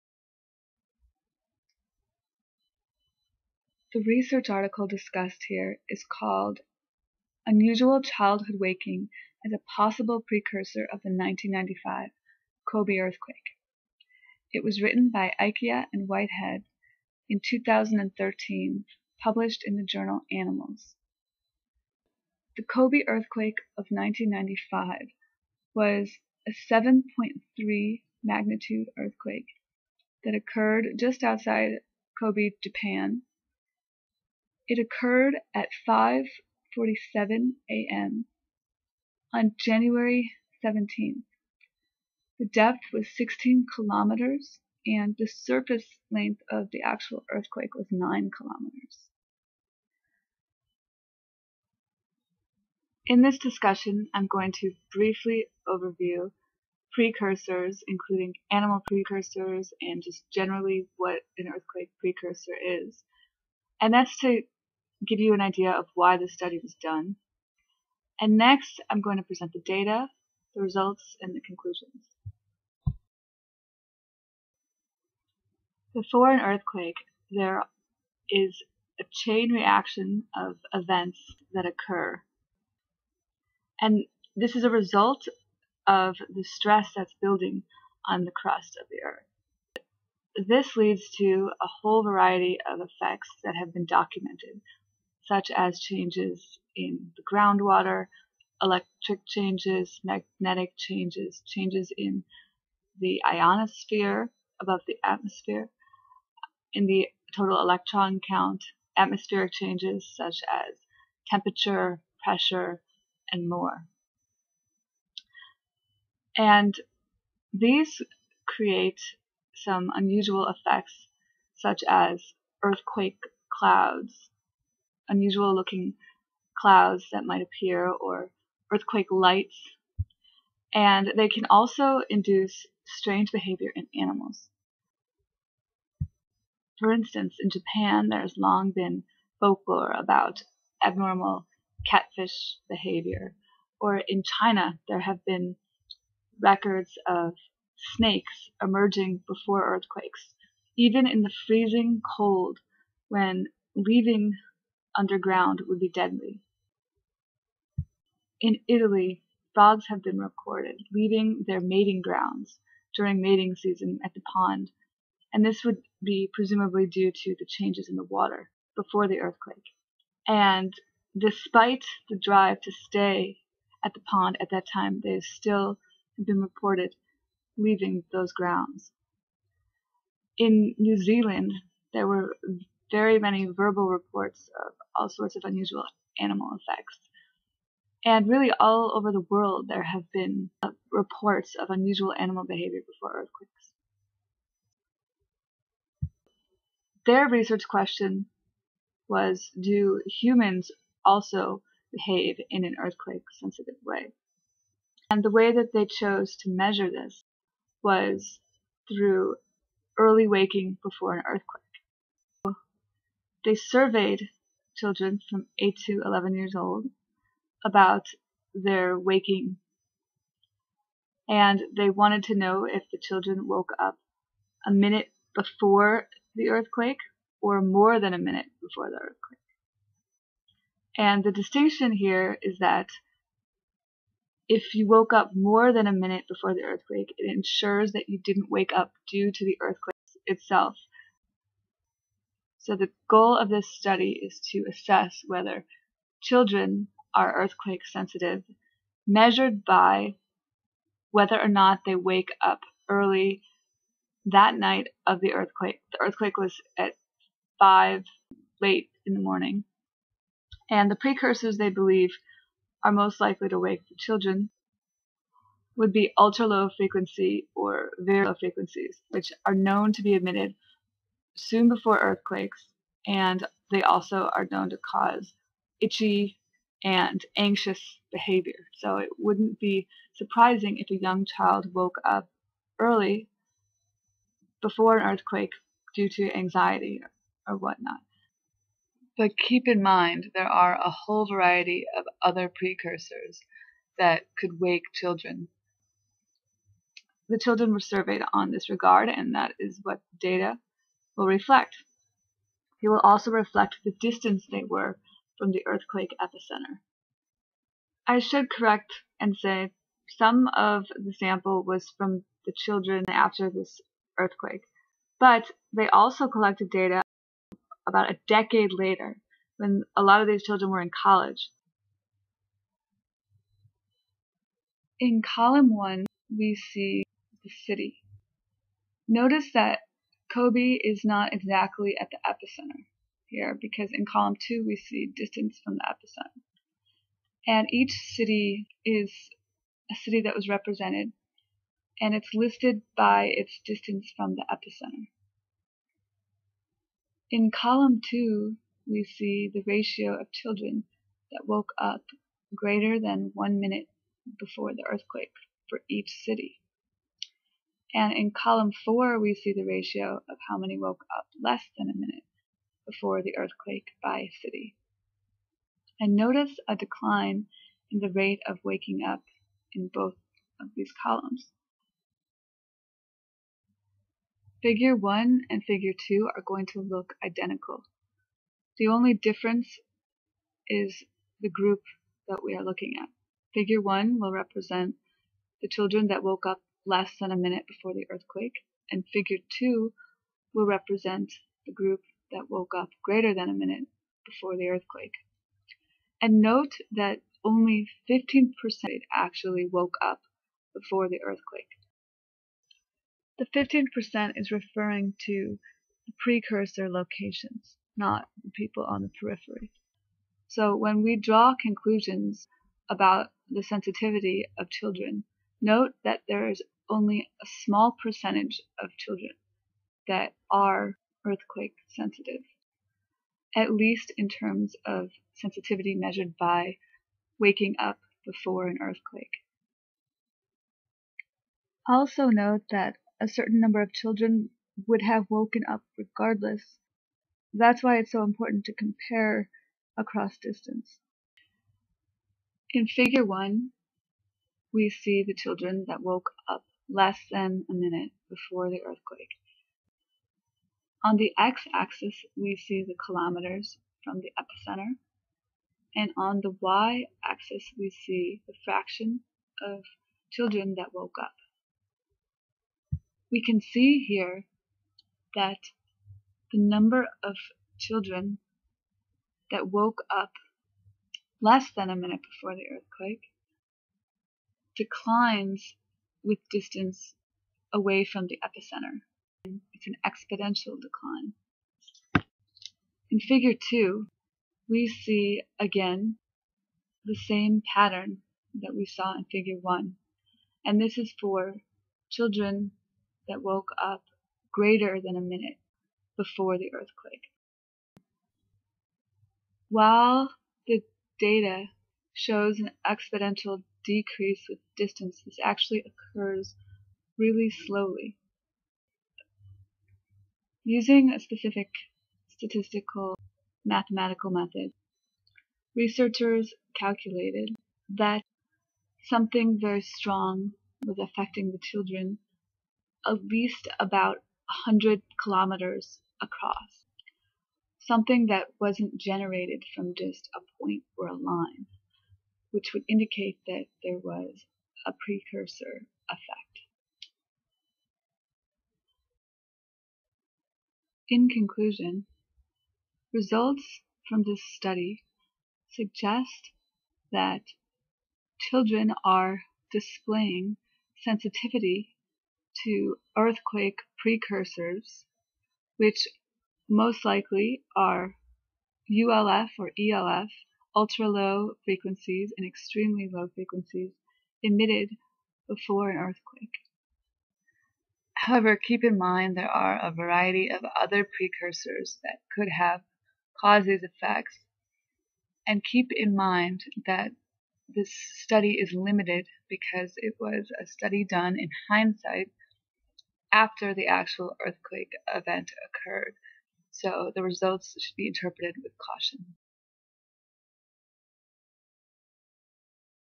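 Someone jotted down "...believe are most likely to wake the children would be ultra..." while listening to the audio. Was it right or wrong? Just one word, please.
right.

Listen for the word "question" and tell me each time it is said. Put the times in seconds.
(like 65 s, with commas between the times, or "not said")
197 s.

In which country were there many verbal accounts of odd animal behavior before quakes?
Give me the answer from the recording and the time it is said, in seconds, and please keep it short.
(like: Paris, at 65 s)
New Zealand, at 180 s.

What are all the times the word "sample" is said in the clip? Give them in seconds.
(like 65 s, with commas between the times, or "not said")
311 s.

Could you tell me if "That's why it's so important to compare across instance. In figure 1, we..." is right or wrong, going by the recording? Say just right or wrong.
wrong.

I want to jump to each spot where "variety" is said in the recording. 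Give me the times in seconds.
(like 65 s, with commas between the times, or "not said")
92 s, 291 s, 569 s.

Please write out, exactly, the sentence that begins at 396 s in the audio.
And note that only 15% actually woke up before the earthquake.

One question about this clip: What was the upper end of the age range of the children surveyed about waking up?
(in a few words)
11.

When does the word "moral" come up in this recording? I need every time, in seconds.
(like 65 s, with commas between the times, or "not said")
not said.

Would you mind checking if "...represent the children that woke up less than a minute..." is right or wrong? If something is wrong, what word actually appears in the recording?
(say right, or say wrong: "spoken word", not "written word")
right.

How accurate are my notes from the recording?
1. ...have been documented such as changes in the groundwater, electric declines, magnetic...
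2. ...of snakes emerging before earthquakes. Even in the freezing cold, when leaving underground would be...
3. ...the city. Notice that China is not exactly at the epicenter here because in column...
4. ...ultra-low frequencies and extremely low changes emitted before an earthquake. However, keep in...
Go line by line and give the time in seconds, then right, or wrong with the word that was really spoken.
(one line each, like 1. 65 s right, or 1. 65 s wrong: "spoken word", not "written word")
1. 93 s wrong: "changes", not "declines"
2. 147 s right
3. 327 s wrong: "Kobe", not "China"
4. 560 s wrong: "frequencies", not "changes".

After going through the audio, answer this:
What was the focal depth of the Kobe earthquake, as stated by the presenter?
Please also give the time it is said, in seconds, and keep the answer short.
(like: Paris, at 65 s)
16 kilometers, at 43 s.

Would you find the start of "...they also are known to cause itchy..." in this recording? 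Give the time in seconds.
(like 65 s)
273 s.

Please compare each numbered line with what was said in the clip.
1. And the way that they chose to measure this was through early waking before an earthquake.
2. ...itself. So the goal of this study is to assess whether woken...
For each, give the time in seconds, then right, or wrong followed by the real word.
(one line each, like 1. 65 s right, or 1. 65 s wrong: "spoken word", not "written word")
1. 205 s right
2. 240 s wrong: "children", not "woken".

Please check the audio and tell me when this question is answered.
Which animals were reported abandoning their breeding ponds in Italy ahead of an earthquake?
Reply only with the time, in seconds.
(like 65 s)
159 s.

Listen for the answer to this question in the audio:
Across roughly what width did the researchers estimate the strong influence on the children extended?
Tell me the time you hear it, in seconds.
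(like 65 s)
524 s.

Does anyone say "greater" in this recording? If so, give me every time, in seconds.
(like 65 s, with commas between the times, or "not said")
352 s, 393 s, 494 s.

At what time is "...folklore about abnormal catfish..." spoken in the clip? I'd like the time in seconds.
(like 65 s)
139 s.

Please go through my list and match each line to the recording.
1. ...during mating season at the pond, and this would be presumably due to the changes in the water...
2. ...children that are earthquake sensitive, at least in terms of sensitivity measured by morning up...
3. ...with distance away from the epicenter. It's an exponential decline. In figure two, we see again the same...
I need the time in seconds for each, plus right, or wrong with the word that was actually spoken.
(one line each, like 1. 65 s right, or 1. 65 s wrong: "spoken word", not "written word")
1. 162 s right
2. 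418 s wrong: "waking", not "morning"
3. 476 s right.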